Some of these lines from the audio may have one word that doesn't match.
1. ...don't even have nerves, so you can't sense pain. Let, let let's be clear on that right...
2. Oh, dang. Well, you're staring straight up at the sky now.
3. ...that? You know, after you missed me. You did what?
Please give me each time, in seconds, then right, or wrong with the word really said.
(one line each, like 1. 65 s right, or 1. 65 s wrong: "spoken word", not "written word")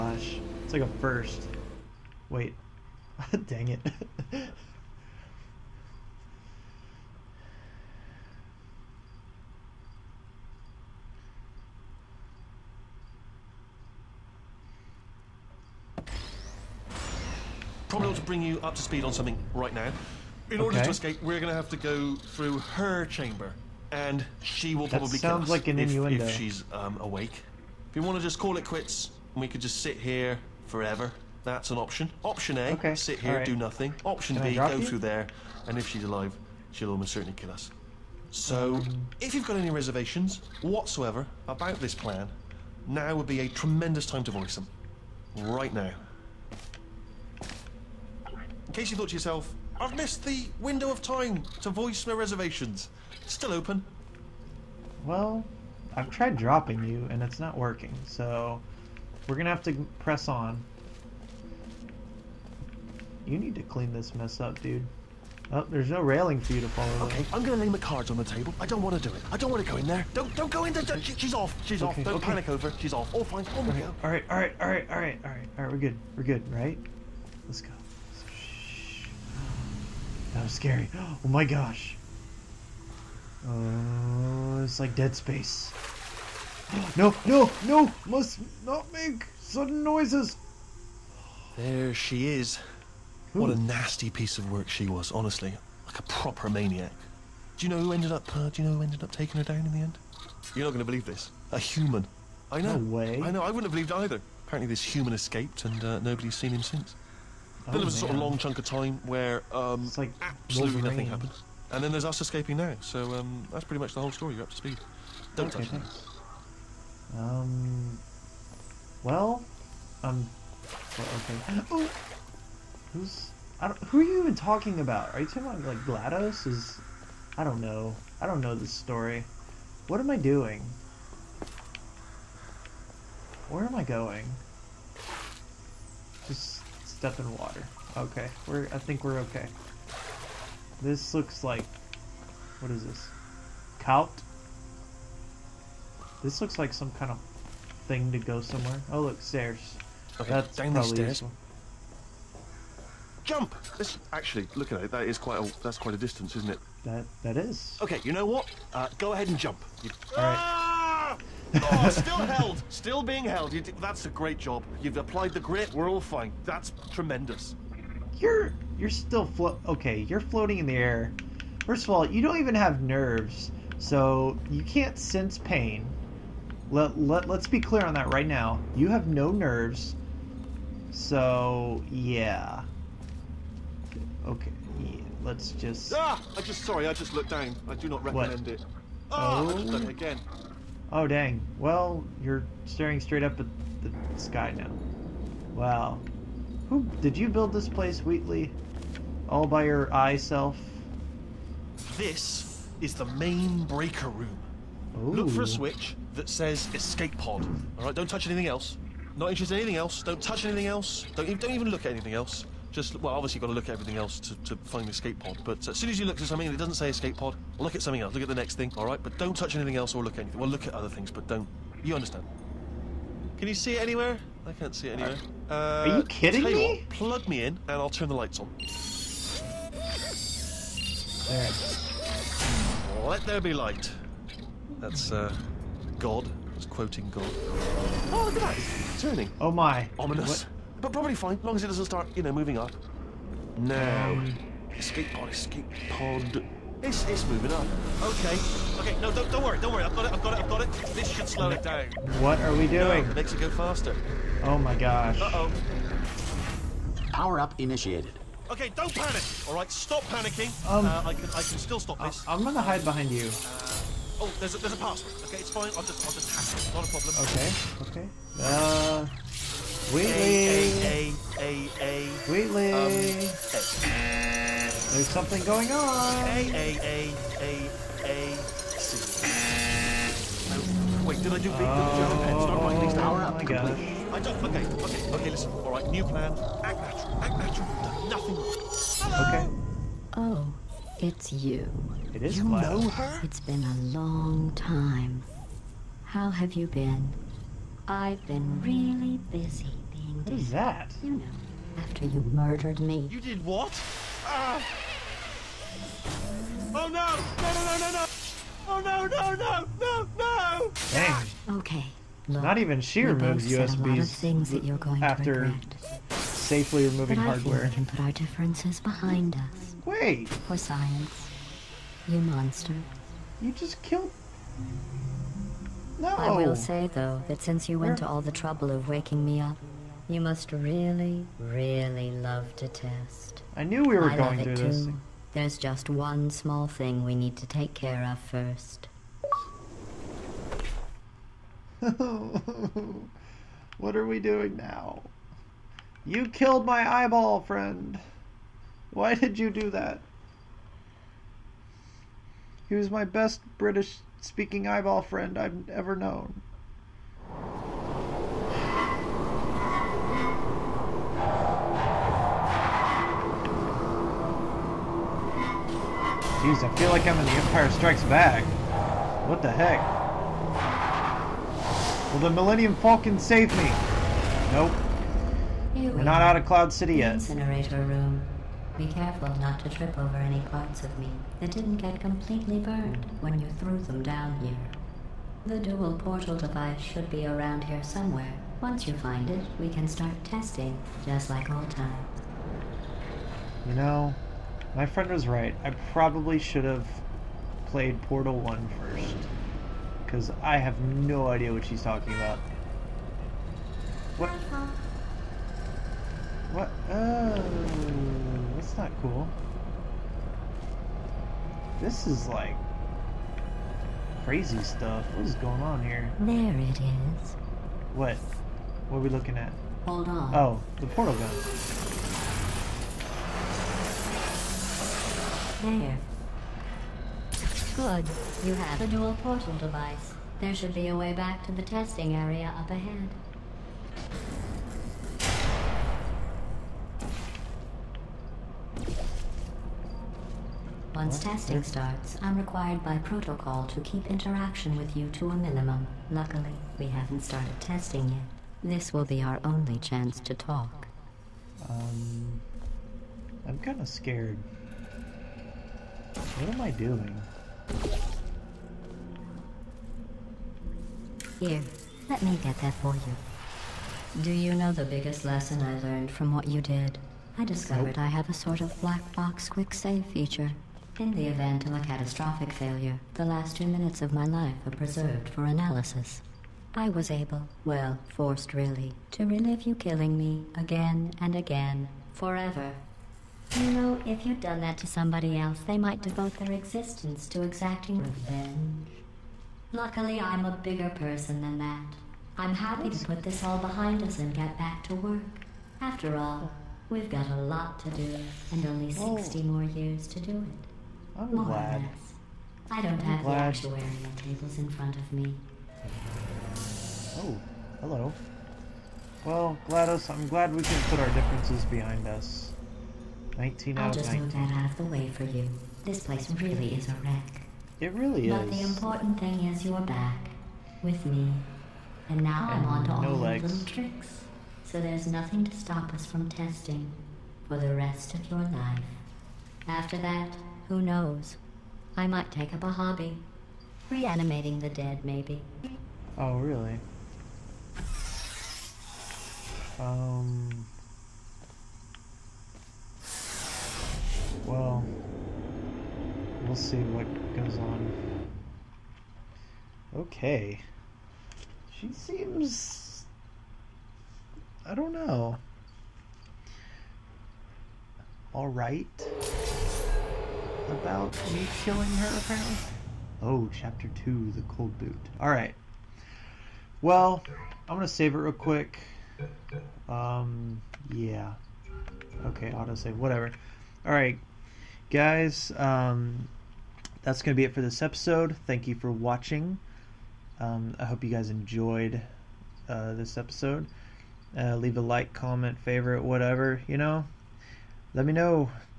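1. 172 s right
2. 190 s right
3. 300 s wrong: "murdered", not "missed".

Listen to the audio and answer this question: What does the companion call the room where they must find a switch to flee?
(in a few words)
Main breaker room.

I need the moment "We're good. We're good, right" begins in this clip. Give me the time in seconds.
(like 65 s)
75 s.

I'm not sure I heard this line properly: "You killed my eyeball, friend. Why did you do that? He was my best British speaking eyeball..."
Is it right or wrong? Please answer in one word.
right.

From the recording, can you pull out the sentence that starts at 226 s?
What, plug me in, and I'll turn the lights on.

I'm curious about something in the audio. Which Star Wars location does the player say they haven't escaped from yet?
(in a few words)
Cloud City.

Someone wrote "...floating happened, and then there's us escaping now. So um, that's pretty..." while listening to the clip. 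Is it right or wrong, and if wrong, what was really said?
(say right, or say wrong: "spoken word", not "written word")
wrong: "nothing", not "floating".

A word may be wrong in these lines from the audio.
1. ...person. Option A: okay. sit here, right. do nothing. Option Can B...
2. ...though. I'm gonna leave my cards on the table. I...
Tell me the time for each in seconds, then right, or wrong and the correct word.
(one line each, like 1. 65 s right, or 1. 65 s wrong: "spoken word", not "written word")
1. 31 s wrong: "option", not "person"
2. 67 s right.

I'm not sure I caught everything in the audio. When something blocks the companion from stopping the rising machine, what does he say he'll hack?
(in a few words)
A password.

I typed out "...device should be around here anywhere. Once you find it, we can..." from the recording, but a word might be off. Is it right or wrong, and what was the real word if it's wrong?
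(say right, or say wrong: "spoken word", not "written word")
wrong: "somewhere", not "anywhere".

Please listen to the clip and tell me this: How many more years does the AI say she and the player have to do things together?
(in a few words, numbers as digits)
60.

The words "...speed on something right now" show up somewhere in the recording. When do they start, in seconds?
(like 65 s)
18 s.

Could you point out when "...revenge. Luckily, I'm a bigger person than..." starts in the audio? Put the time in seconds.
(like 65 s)
487 s.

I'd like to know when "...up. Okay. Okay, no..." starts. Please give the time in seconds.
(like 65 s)
247 s.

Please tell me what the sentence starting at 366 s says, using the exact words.
Jeez, I feel like I'm in The Empire Strikes Back.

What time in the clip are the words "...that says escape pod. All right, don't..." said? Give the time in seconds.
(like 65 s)
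206 s.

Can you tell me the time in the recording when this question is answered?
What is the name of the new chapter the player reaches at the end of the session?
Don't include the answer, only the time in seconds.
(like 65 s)
564 s.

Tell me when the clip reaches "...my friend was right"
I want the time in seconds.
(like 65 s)
394 s.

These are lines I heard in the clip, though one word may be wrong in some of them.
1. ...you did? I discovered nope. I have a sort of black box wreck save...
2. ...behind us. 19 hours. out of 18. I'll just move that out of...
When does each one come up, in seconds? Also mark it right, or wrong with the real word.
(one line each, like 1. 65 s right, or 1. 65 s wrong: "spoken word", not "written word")
1. 466 s wrong: "quick", not "wreck"
2. 511 s wrong: "19", not "18".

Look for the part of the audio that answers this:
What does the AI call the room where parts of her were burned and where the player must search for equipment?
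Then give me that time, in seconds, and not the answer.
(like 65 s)
377 s.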